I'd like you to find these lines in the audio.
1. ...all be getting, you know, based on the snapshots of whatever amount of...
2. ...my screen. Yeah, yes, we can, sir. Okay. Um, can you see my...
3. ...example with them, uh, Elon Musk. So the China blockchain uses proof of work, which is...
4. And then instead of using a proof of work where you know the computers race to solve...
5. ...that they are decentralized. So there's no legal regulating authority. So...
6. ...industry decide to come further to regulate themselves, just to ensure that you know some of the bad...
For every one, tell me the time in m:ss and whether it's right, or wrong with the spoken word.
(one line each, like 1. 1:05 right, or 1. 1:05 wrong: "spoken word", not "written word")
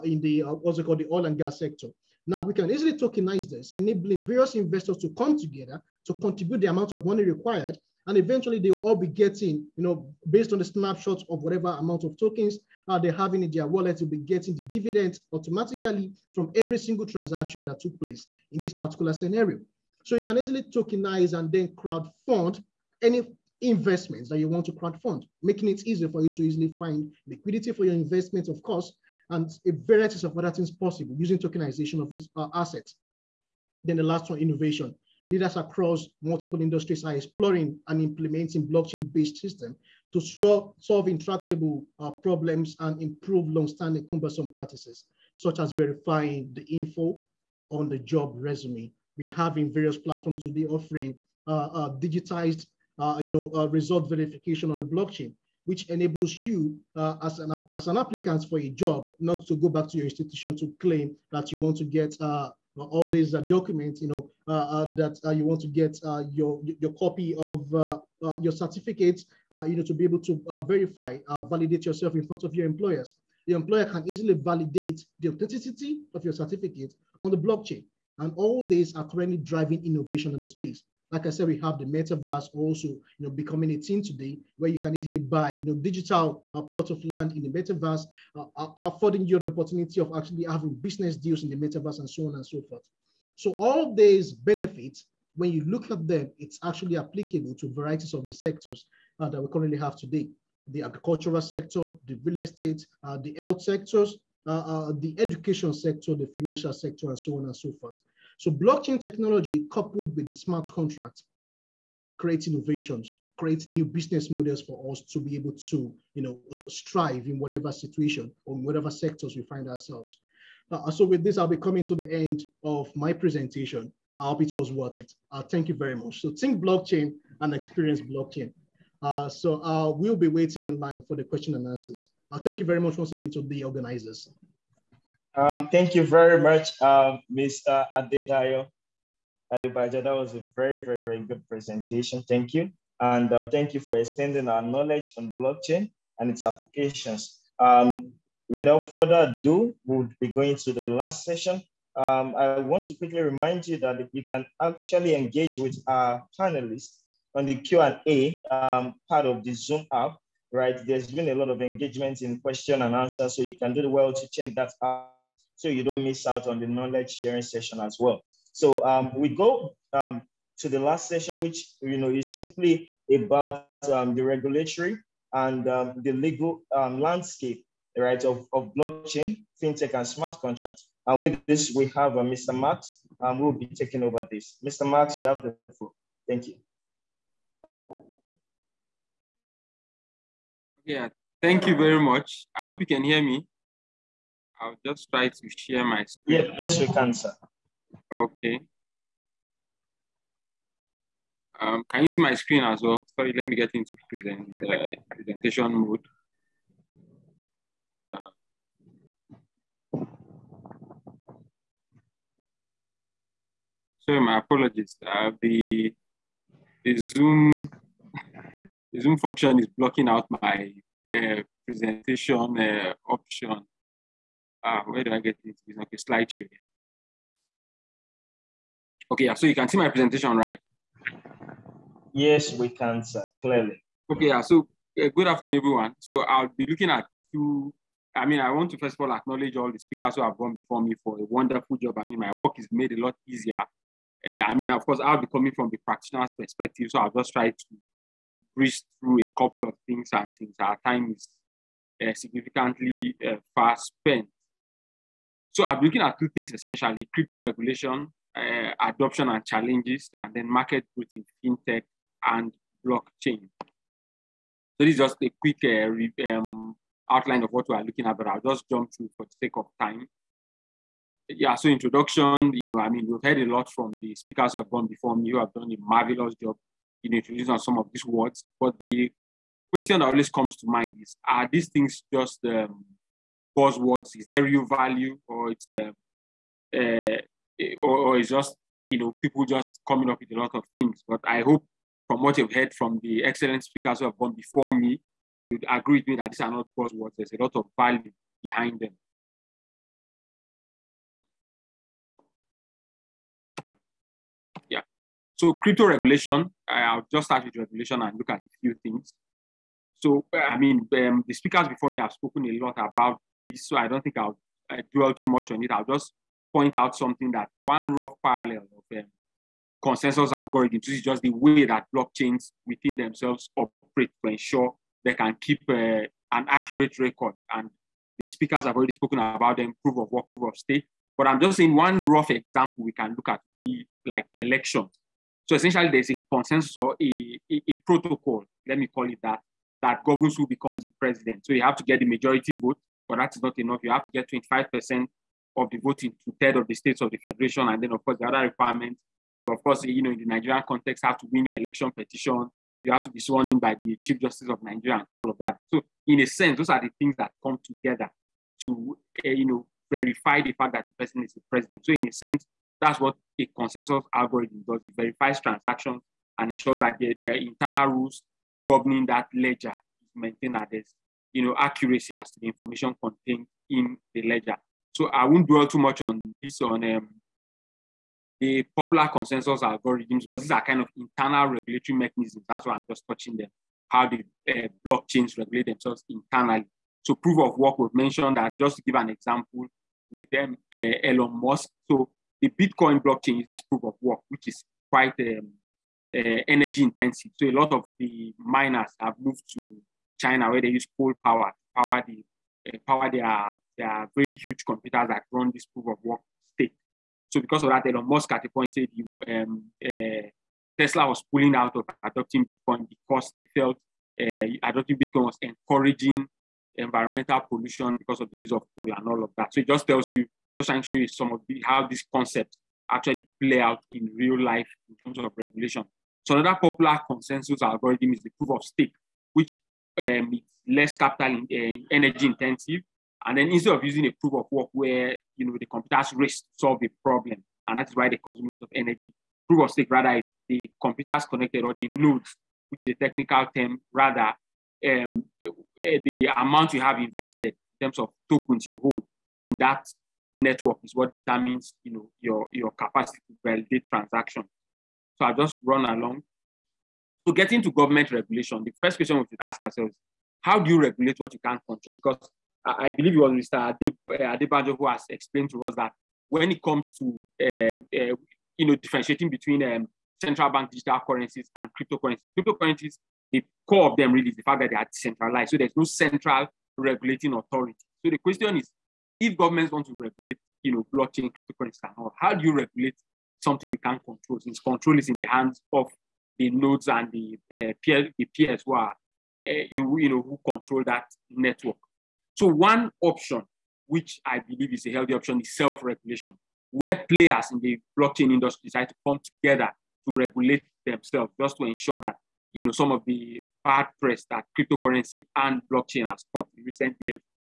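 1. 0:08 right
2. 3:15 right
3. 6:29 wrong: "Bitcoin", not "China"
4. 7:13 right
5. 7:54 wrong: "central", not "legal"
6. 8:18 wrong: "together", not "further".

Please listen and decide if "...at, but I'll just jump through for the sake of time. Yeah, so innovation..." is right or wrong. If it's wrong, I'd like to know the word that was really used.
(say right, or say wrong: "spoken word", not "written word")
wrong: "introduction", not "innovation".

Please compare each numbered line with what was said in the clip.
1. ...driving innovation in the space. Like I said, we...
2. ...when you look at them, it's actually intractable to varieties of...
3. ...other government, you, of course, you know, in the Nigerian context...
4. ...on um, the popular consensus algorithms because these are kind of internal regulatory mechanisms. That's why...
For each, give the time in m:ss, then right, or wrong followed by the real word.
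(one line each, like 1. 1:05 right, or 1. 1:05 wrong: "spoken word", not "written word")
1. 1:19 right
2. 1:35 wrong: "applicable", not "intractable"
3. 5:48 wrong: "requirement", not "government"
4. 6:16 right.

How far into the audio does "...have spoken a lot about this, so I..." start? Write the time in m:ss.
5:11.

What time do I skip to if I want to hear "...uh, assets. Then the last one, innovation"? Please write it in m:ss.
0:32.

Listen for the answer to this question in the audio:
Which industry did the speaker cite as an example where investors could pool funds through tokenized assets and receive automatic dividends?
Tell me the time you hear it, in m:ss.
0:01.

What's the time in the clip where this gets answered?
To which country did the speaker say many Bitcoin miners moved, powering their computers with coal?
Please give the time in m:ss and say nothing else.
6:40.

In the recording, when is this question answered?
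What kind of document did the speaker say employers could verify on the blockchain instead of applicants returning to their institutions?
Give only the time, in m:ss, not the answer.
0:47.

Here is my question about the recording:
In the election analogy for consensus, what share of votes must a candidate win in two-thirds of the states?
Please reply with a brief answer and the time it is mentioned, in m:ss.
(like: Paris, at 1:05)
25%, at 5:44.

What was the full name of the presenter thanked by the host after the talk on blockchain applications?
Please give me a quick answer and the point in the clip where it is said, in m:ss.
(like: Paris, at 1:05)
Adedayo Adebajo, at 2:17.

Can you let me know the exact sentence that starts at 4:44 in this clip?
Is there real value or it's uh, or, or it's just, you know, people just coming up with a lot of things.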